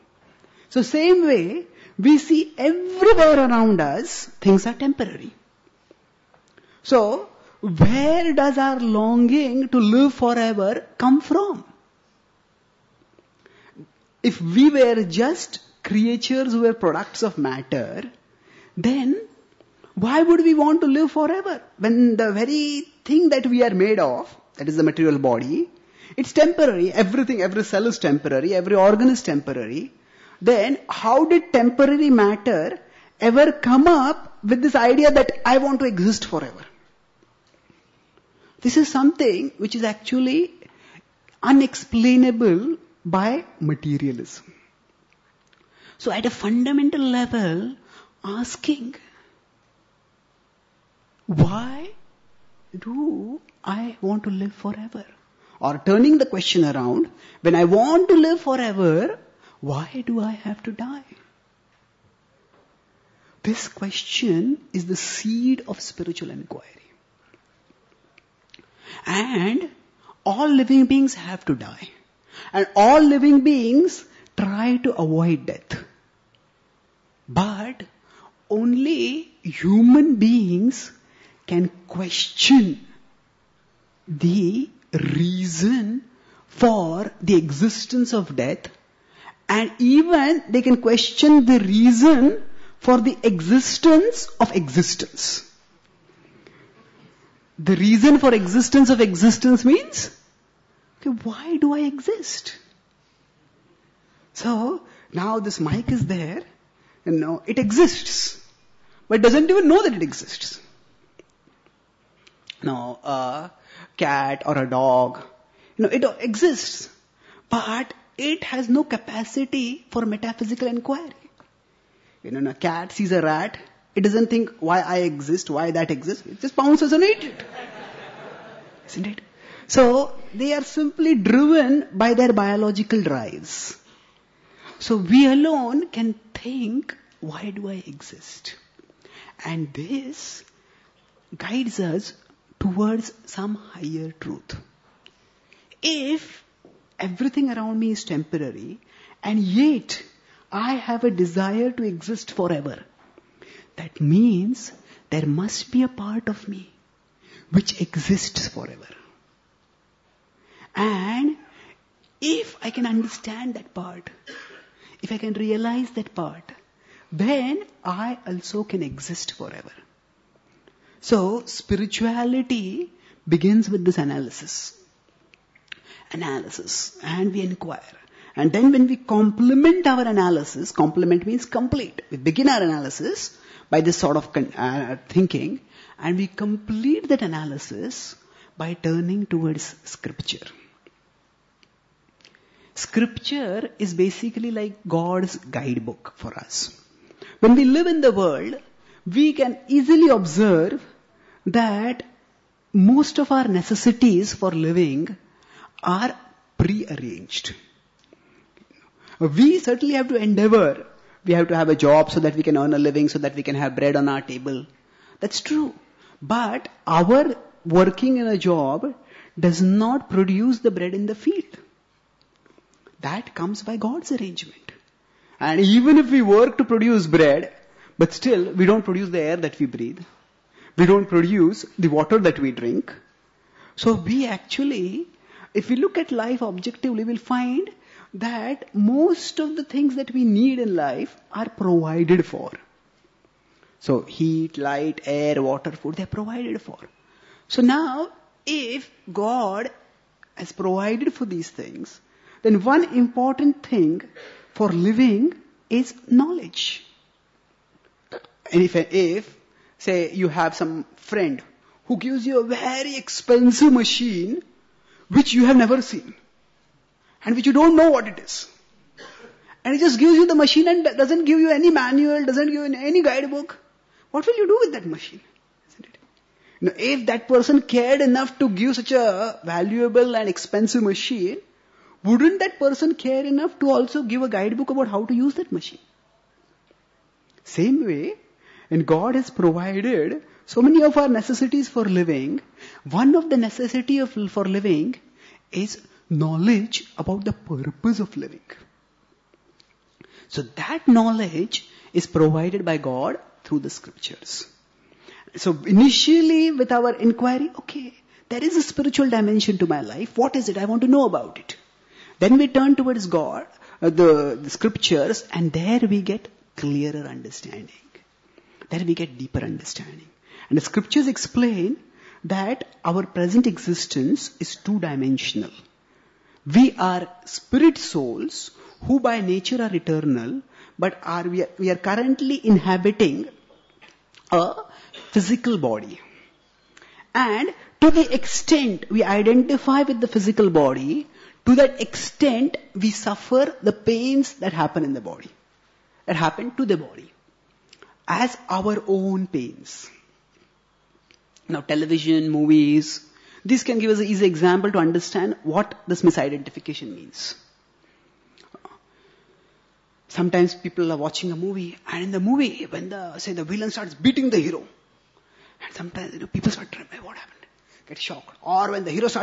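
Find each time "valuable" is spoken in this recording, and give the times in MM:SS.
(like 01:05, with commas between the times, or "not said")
04:39.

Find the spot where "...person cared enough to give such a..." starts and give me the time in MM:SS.
04:37.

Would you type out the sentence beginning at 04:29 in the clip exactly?
And he just gives you the machine and doesn't give you any manual, doesn't give you any guidebook.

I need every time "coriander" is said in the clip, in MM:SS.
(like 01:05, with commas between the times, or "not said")
not said.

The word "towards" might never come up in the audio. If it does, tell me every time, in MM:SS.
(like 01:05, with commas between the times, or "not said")
02:22, 03:09, 05:12.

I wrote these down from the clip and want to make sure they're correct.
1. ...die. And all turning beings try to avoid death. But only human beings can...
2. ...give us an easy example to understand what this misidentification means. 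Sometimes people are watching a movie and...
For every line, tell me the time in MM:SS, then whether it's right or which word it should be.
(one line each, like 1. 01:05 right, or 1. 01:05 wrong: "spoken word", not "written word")
1. 01:11 wrong: "living", not "turning"
2. 05:53 right.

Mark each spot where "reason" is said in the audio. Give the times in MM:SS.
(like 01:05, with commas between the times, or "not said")
01:24, 01:31, 01:37.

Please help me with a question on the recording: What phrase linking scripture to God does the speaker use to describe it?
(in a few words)
God's guidebook.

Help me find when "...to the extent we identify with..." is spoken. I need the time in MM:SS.
05:37.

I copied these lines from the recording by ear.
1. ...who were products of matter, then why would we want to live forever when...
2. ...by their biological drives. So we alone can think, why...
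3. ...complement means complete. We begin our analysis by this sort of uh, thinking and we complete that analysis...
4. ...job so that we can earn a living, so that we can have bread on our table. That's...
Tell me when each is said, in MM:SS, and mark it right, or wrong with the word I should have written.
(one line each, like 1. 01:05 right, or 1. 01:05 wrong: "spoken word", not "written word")
1. 00:16 right
2. 02:11 right
3. 03:00 right
4. 03:31 right.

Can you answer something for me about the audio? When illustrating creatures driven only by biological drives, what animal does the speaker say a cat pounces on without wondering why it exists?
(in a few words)
A rat.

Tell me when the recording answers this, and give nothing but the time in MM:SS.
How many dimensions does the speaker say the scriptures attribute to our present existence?
05:24.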